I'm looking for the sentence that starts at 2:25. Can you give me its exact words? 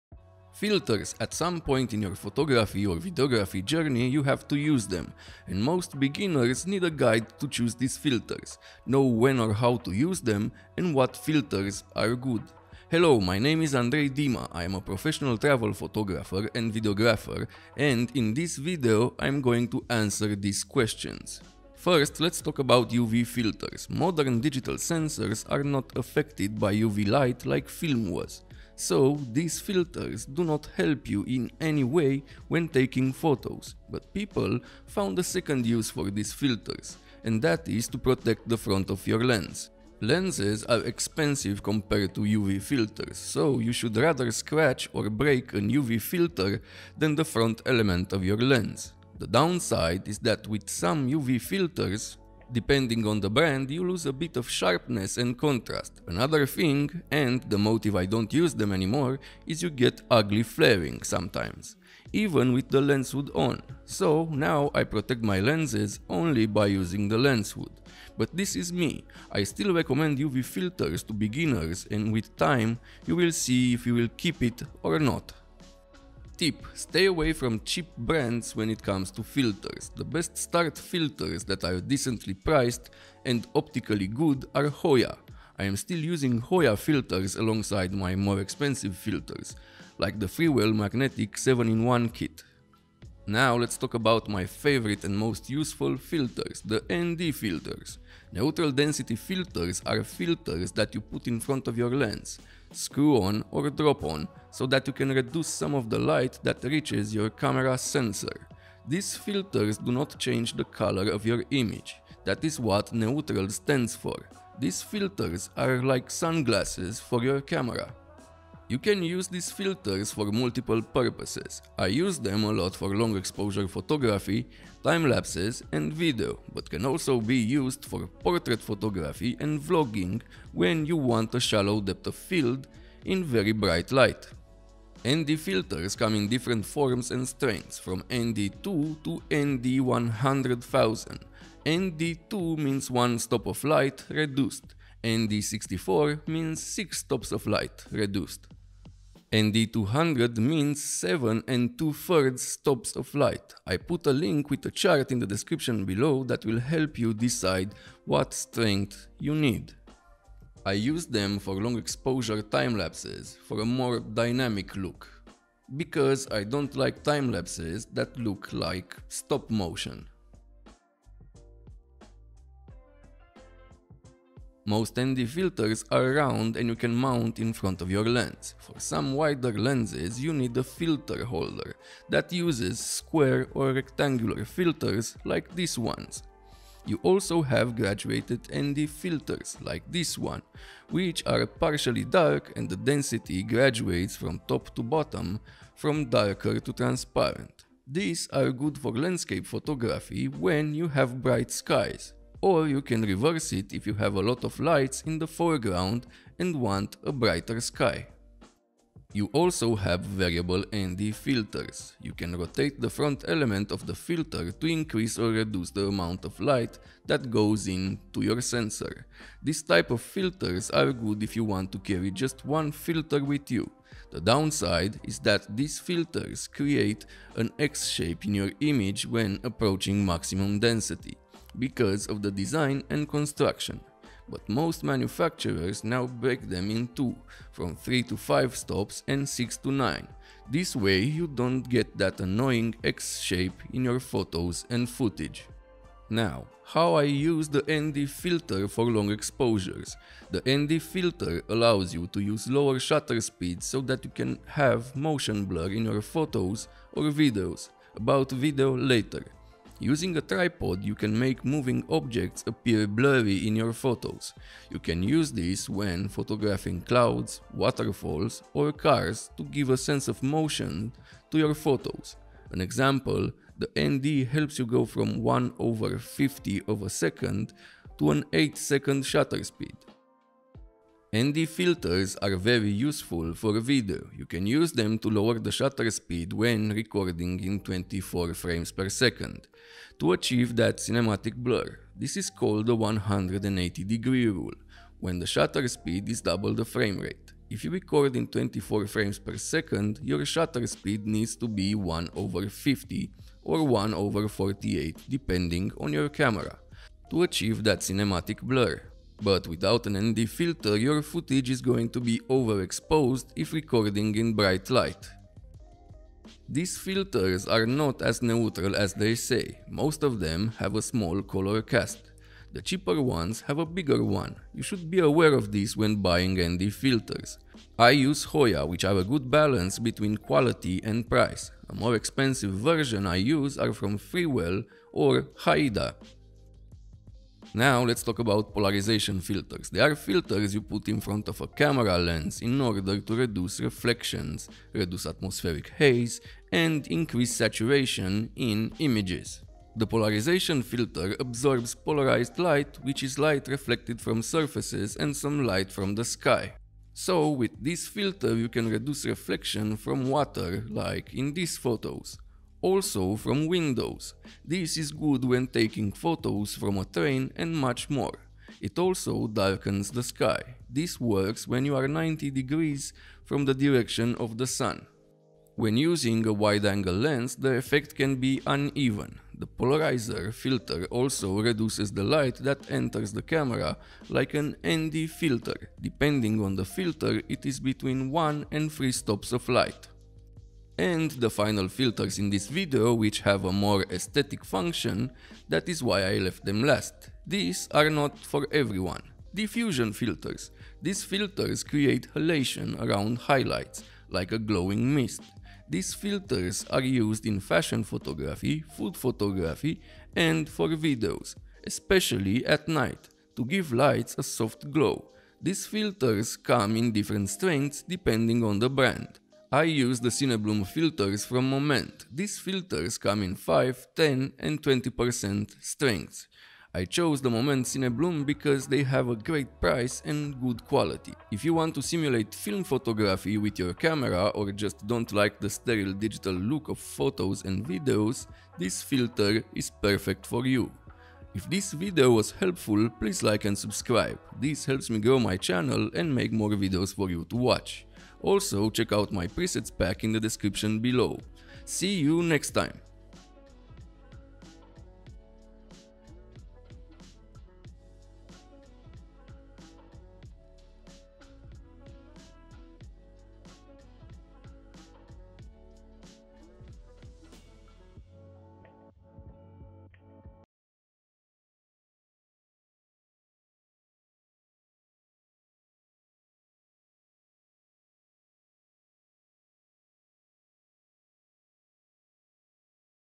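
ND64 means six stops of light, reduced and the 200 means 7 and 2 thirds stops of light.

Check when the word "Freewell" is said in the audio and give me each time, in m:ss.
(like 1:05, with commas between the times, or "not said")
1:30, 5:33.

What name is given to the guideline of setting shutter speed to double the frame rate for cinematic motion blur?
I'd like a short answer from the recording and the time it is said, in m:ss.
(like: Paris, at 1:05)
180 degree rule, at 4:52.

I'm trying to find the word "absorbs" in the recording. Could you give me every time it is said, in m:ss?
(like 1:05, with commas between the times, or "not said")
5:51.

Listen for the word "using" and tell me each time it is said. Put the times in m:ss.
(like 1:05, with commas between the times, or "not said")
1:06, 1:26, 4:19, 6:15.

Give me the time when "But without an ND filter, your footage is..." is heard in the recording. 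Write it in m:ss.
5:09.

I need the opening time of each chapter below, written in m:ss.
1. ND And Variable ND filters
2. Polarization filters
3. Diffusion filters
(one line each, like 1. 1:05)
1. 1:32
2. 5:36
3. 6:30.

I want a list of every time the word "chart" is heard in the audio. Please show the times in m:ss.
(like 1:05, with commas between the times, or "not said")
2:34.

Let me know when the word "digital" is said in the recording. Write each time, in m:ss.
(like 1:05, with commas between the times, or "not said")
0:24, 7:15.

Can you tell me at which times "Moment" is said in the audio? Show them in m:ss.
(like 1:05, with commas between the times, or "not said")
7:01, 7:07.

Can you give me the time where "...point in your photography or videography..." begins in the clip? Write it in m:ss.
0:01.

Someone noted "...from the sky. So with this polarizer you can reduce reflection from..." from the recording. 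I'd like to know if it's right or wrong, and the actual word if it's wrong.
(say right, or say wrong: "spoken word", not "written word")
wrong: "filter", not "polarizer".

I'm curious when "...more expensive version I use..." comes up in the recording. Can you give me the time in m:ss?
5:31.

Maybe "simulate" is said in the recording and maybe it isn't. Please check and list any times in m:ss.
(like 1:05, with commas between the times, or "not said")
7:11.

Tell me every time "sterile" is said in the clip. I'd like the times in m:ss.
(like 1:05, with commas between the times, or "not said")
7:15.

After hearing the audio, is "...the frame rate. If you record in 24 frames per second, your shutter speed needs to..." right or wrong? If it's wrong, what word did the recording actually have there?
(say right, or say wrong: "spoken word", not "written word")
right.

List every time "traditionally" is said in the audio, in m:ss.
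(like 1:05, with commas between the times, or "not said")
not said.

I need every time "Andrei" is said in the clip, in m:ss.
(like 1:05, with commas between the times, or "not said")
0:13.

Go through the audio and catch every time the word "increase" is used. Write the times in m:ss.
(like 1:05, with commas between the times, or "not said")
3:34, 5:46.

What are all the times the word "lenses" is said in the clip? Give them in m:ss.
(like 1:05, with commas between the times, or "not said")
0:40, 1:05, 2:59.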